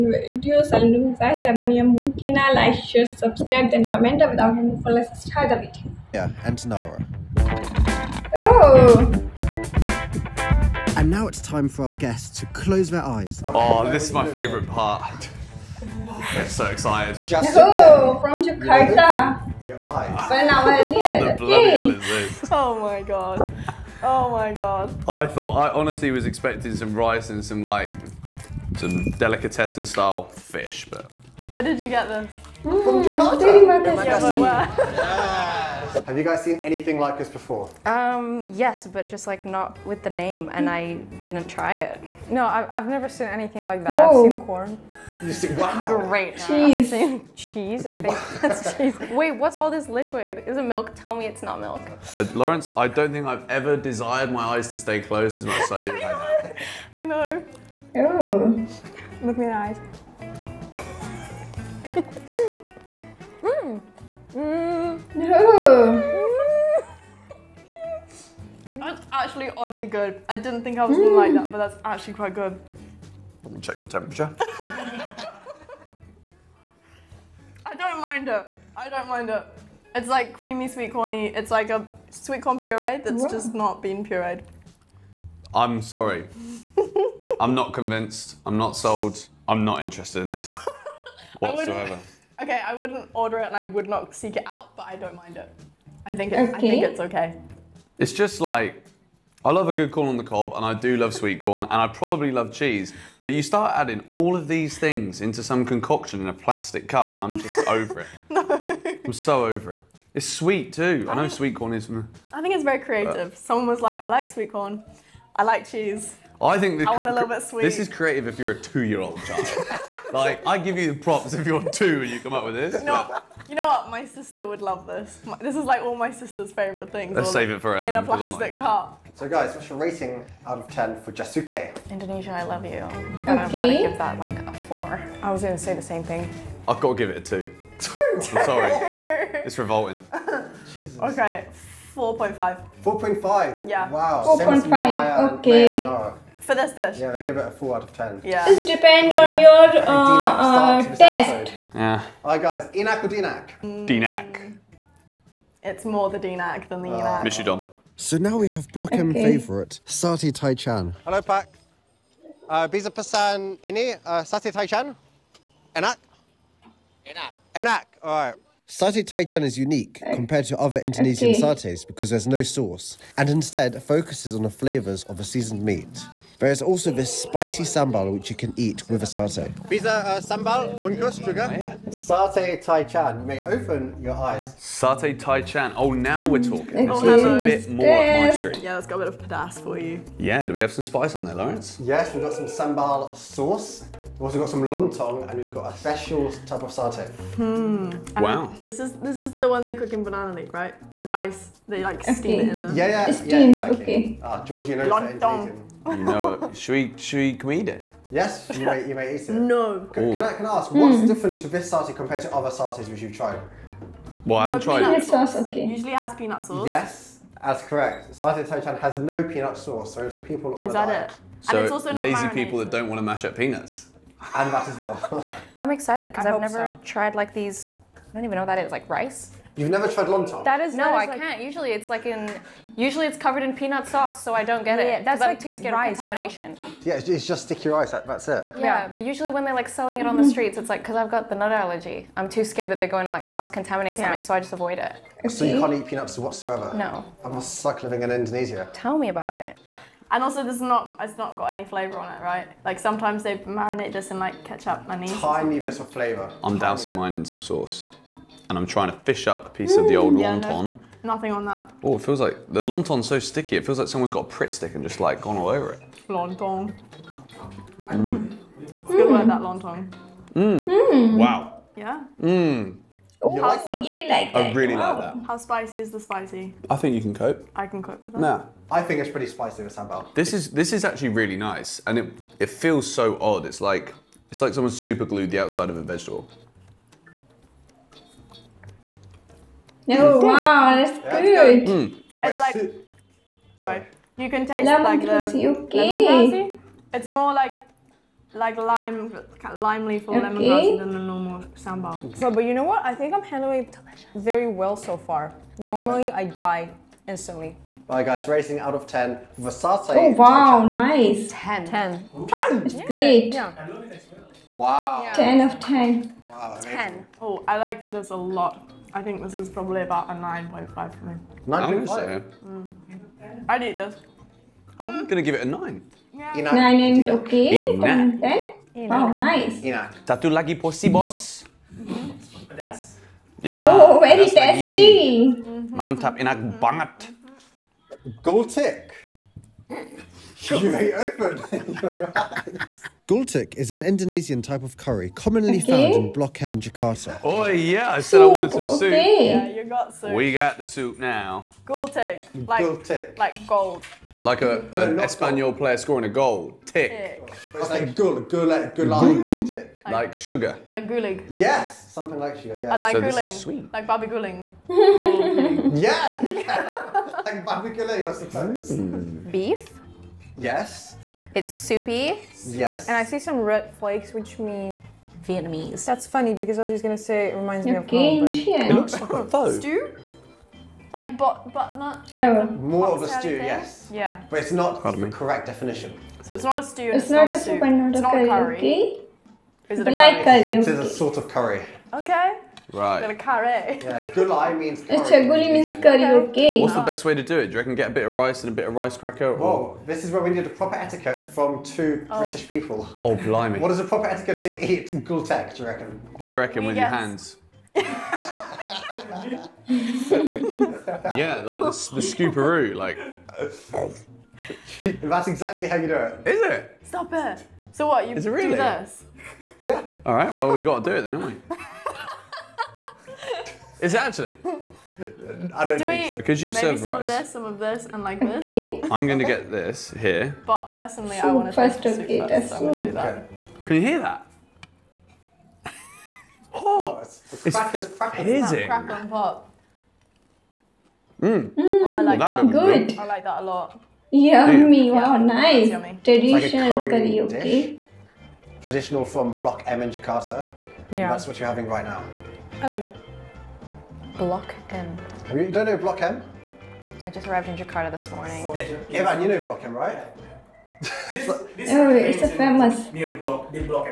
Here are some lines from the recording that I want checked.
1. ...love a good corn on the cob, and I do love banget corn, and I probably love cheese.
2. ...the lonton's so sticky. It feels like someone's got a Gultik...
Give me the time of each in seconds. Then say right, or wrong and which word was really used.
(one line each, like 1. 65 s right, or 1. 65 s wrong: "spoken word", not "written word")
1. 99 s wrong: "sweet", not "banget"
2. 262 s wrong: "Pritt", not "Gultik".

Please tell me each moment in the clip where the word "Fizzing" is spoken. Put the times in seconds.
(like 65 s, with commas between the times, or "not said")
438 s.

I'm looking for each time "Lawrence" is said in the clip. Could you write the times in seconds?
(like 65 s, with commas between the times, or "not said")
52 s, 191 s.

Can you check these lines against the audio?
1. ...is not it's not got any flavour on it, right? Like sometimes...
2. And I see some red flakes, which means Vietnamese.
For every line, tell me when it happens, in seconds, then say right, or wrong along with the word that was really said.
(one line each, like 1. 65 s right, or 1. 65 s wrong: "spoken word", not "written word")
1. 250 s right
2. 372 s right.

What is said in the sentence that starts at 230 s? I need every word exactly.
That is no, that is I like, can't.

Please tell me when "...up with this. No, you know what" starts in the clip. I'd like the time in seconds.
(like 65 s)
122 s.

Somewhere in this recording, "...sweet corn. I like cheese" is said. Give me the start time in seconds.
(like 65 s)
114 s.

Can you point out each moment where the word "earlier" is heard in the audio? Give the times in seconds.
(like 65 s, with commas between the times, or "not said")
20 s.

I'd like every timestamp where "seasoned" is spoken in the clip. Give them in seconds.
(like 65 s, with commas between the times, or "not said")
175 s.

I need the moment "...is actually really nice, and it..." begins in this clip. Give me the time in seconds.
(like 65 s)
280 s.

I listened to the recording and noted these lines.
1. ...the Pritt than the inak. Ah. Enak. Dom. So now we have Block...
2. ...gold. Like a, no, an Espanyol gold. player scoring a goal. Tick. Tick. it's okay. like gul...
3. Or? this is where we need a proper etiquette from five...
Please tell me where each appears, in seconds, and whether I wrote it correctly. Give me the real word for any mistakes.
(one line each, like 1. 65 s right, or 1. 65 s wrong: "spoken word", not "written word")
1. 156 s wrong: "Dinak", not "Pritt"
2. 353 s right
3. 399 s wrong: "two", not "five".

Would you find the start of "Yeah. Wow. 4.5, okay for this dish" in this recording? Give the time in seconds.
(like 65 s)
143 s.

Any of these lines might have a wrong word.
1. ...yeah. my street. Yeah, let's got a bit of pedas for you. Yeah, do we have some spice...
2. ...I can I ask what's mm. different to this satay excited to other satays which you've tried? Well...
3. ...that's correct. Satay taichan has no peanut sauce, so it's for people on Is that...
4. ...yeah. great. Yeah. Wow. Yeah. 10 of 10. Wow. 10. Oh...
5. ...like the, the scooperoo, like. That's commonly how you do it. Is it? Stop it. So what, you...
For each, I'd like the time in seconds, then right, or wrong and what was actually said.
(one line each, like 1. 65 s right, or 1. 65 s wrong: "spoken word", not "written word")
1. 187 s right
2. 210 s wrong: "compared", not "excited"
3. 217 s right
4. 312 s right
5. 411 s wrong: "exactly", not "commonly".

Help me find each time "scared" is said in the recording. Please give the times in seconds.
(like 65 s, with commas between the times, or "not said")
235 s, 242 s.